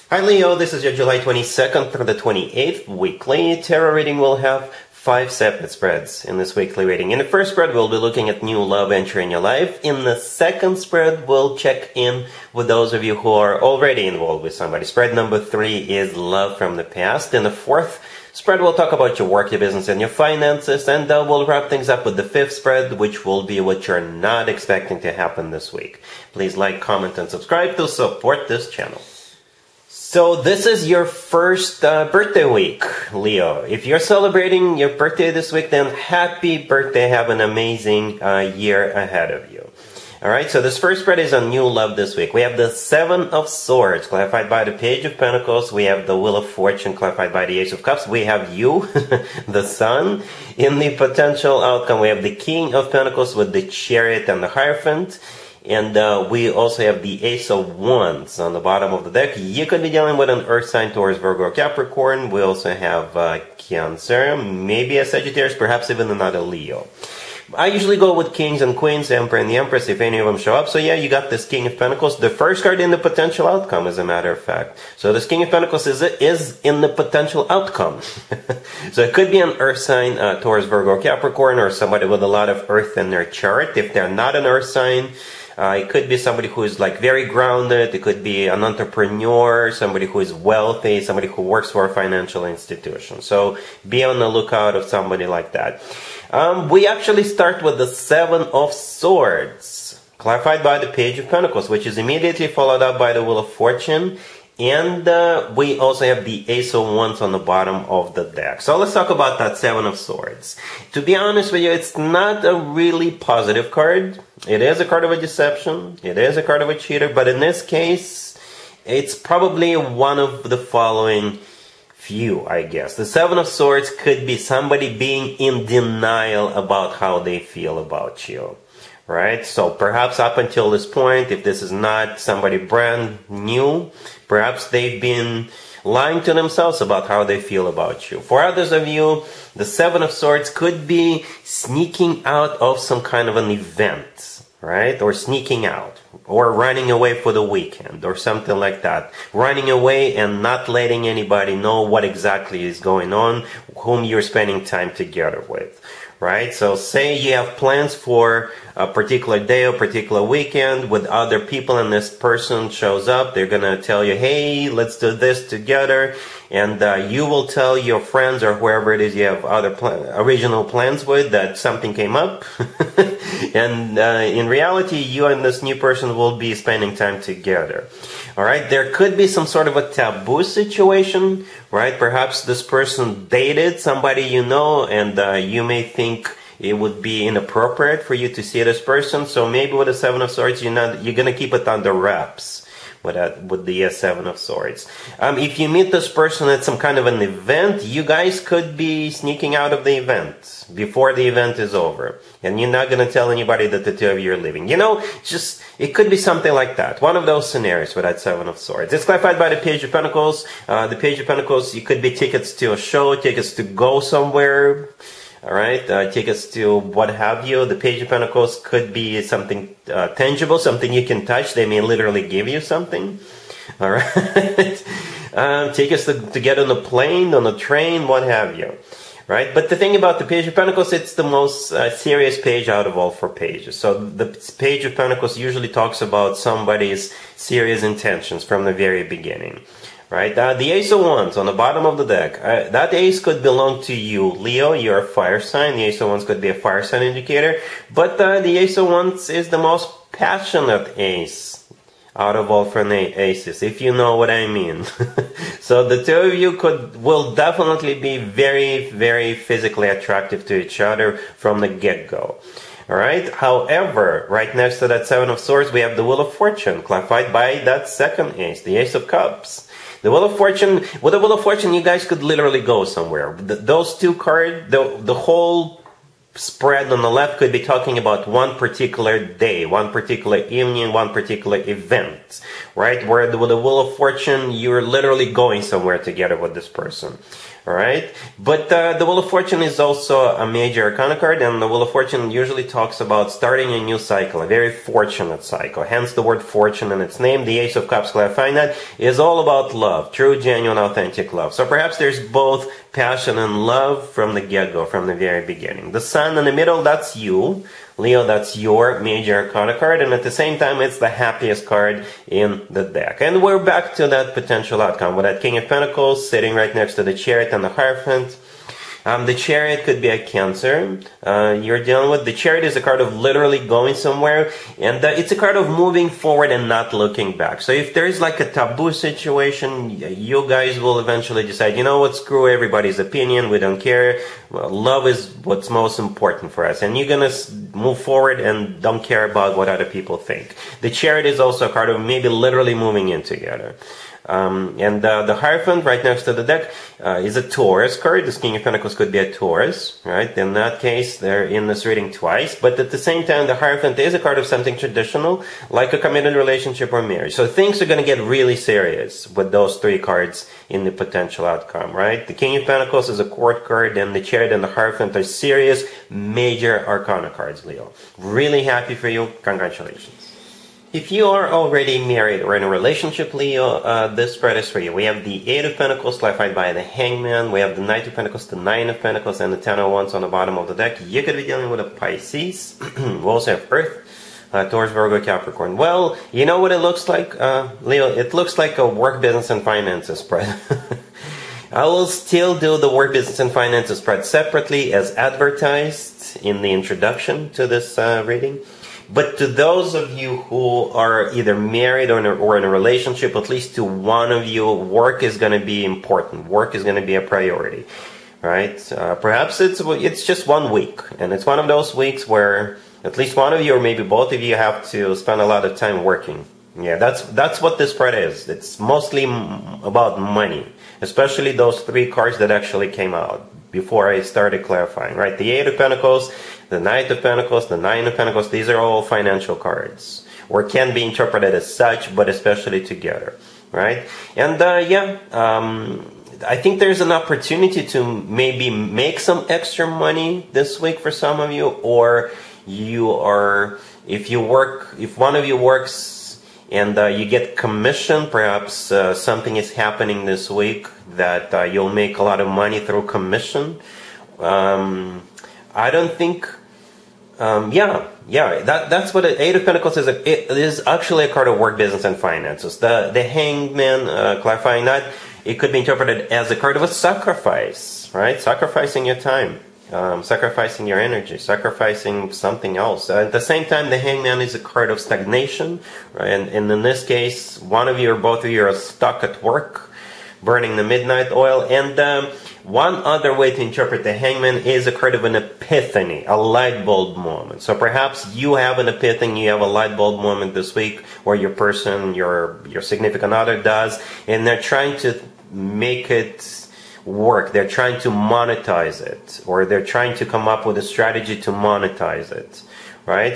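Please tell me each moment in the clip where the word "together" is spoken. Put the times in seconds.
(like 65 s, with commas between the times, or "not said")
154 s, 165 s, 177 s, 285 s, 343 s, 432 s.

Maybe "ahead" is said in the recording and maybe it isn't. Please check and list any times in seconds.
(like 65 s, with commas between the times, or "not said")
38 s.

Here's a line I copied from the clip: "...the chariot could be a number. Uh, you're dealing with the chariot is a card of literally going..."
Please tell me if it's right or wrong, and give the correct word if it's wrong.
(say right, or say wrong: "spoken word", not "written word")
wrong: "cancer", not "number".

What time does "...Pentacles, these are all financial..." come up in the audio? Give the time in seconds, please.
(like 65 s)
428 s.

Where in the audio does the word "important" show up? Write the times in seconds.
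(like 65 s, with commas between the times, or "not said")
335 s, 405 s.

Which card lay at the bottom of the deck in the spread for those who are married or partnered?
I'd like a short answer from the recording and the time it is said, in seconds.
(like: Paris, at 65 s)
Ten of Wands, at 379 s.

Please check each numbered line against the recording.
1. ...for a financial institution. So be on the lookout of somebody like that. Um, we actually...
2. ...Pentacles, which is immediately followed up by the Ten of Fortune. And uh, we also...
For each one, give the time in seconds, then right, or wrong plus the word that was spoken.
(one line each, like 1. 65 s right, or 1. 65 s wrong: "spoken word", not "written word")
1. 91 s right
2. 101 s wrong: "Wheel", not "Ten".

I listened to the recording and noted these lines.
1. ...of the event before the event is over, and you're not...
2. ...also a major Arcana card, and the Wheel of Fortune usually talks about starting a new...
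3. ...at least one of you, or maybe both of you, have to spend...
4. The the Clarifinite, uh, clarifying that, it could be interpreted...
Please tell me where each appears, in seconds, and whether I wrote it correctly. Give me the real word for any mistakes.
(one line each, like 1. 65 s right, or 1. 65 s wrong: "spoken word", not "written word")
1. 199 s right
2. 289 s right
3. 413 s right
4. 462 s wrong: "Hangman", not "Clarifinite".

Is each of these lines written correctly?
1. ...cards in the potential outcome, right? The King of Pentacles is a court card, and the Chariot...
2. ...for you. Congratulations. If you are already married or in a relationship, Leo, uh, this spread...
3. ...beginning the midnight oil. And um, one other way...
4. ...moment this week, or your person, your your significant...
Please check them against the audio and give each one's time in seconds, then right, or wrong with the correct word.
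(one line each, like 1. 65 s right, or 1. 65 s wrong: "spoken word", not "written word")
1. 359 s right
2. 368 s right
3. 480 s wrong: "burning", not "beginning"
4. 490 s right.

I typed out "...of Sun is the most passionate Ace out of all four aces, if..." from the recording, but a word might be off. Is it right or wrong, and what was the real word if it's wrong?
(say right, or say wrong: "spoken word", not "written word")
wrong: "Wands", not "Sun".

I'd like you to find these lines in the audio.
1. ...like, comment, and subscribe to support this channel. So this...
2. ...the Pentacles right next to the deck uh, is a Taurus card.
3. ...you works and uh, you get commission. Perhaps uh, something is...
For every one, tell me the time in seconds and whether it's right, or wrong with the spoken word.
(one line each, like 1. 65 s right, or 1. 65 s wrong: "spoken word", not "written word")
1. 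26 s right
2. 345 s wrong: "Hierophant", not "Pentacles"
3. 445 s right.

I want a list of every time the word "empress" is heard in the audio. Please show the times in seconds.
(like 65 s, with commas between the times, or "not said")
69 s.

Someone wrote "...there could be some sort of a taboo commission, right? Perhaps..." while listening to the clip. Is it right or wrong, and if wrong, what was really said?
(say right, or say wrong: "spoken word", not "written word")
wrong: "situation", not "commission".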